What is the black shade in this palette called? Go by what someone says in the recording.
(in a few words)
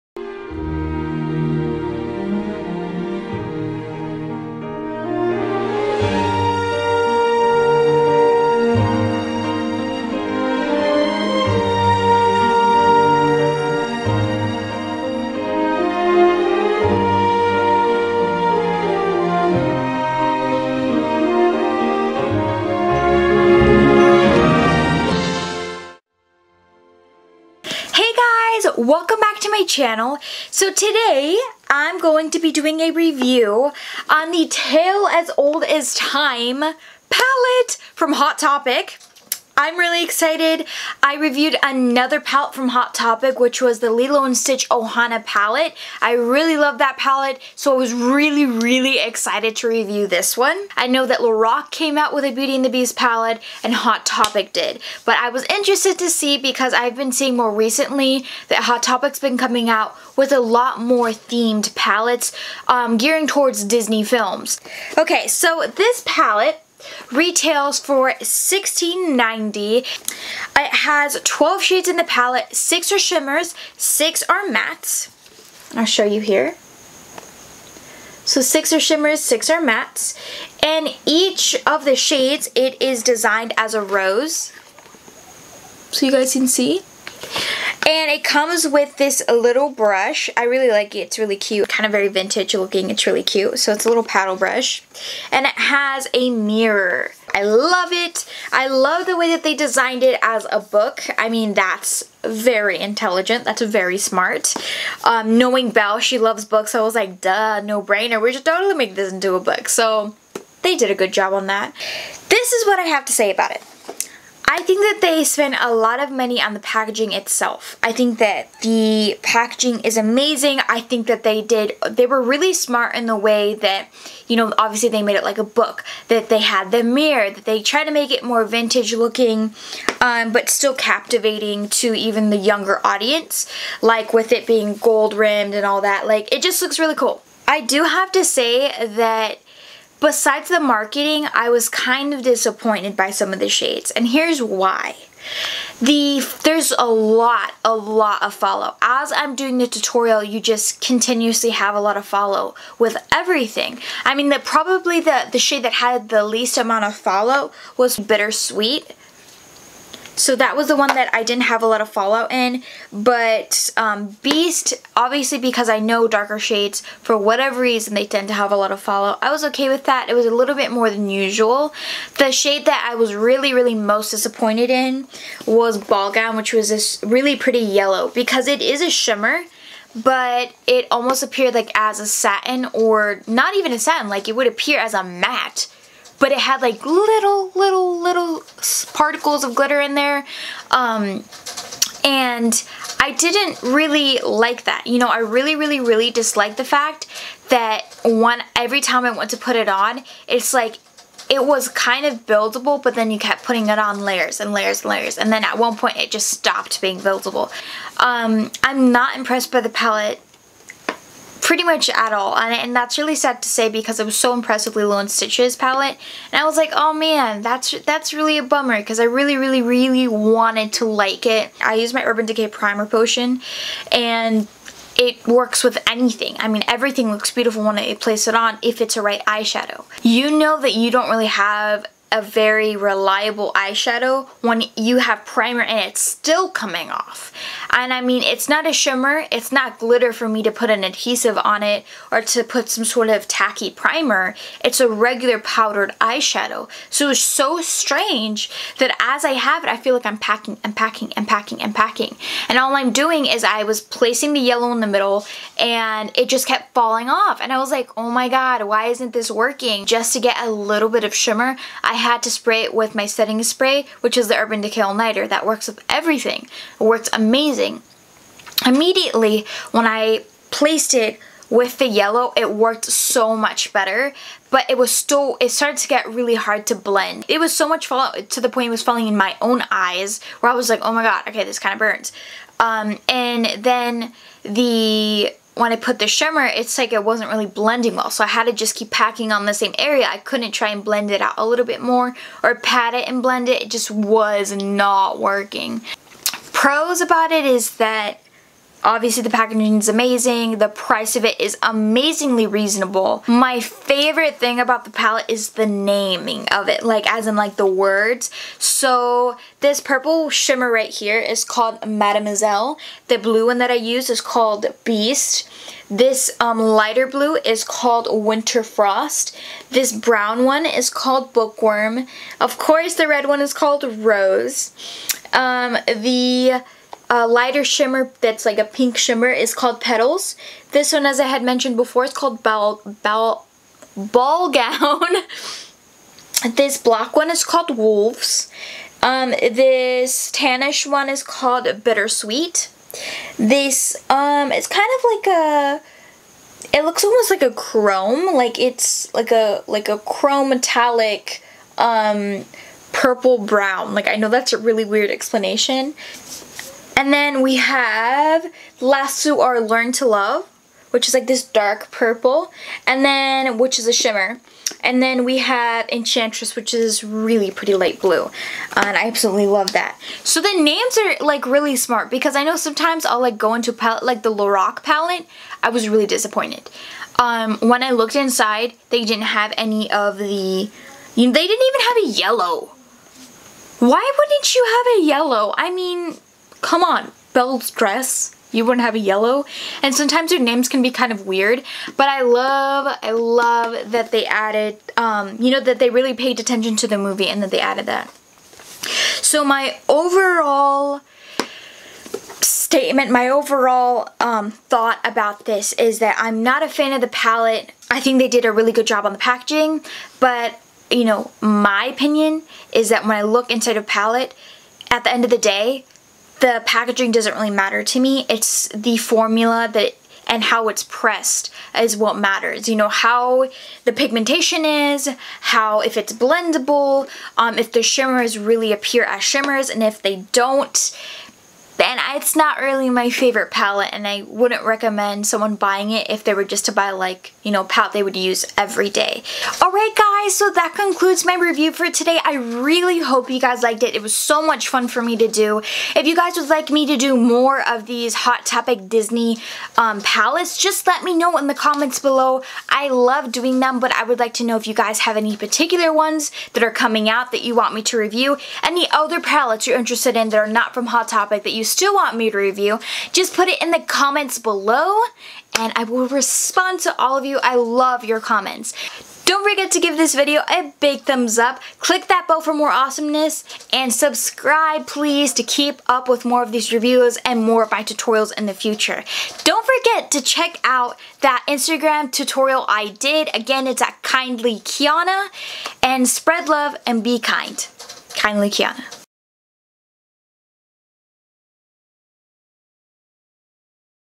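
Wolves.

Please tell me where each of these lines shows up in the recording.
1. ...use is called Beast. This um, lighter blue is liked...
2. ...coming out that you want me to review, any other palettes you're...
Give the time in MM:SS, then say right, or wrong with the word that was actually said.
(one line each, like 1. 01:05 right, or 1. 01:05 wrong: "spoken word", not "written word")
1. 05:13 wrong: "called", not "liked"
2. 07:36 right.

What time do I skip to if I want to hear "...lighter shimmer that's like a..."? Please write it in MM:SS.
05:27.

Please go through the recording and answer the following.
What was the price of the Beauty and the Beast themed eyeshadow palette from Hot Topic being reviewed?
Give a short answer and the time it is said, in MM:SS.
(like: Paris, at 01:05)
$16.90, at 01:08.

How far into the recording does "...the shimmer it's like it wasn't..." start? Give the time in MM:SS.
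04:45.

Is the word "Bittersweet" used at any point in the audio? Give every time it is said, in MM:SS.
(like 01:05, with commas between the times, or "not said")
02:37, 05:41.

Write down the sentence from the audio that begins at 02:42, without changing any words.
But um, Beast, obviously because I know darker shades, for whatever reason, they tend to have a lot of fallout.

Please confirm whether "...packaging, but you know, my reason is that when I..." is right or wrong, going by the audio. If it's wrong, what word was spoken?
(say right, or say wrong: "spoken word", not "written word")
wrong: "opinion", not "reason".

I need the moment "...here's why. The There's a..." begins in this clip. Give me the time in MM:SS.
02:24.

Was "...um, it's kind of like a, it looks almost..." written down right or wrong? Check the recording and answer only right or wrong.
right.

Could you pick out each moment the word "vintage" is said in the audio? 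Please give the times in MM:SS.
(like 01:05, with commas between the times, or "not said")
01:32, 02:08.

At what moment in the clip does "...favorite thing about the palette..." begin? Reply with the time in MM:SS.
05:03.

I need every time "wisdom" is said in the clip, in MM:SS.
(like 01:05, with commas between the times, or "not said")
not said.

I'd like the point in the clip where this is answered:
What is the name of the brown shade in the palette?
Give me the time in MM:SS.
05:21.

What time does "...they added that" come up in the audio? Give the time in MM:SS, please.
06:37.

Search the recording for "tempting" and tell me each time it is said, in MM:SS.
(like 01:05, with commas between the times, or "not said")
not said.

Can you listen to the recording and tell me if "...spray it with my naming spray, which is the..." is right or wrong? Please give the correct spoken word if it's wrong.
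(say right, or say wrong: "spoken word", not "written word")
wrong: "setting", not "naming".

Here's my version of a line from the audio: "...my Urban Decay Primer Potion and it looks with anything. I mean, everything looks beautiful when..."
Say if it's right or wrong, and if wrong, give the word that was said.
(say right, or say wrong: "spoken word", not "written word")
wrong: "works", not "looks".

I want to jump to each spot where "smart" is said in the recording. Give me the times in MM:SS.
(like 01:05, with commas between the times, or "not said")
01:43, 02:02, 06:11.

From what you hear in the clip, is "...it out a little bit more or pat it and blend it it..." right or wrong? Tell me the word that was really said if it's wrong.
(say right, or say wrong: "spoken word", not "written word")
right.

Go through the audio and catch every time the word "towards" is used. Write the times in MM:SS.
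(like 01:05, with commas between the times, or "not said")
01:03.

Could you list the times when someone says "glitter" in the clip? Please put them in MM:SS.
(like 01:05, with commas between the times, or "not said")
03:09, 03:59.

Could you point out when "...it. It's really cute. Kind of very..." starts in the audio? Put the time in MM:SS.
01:30.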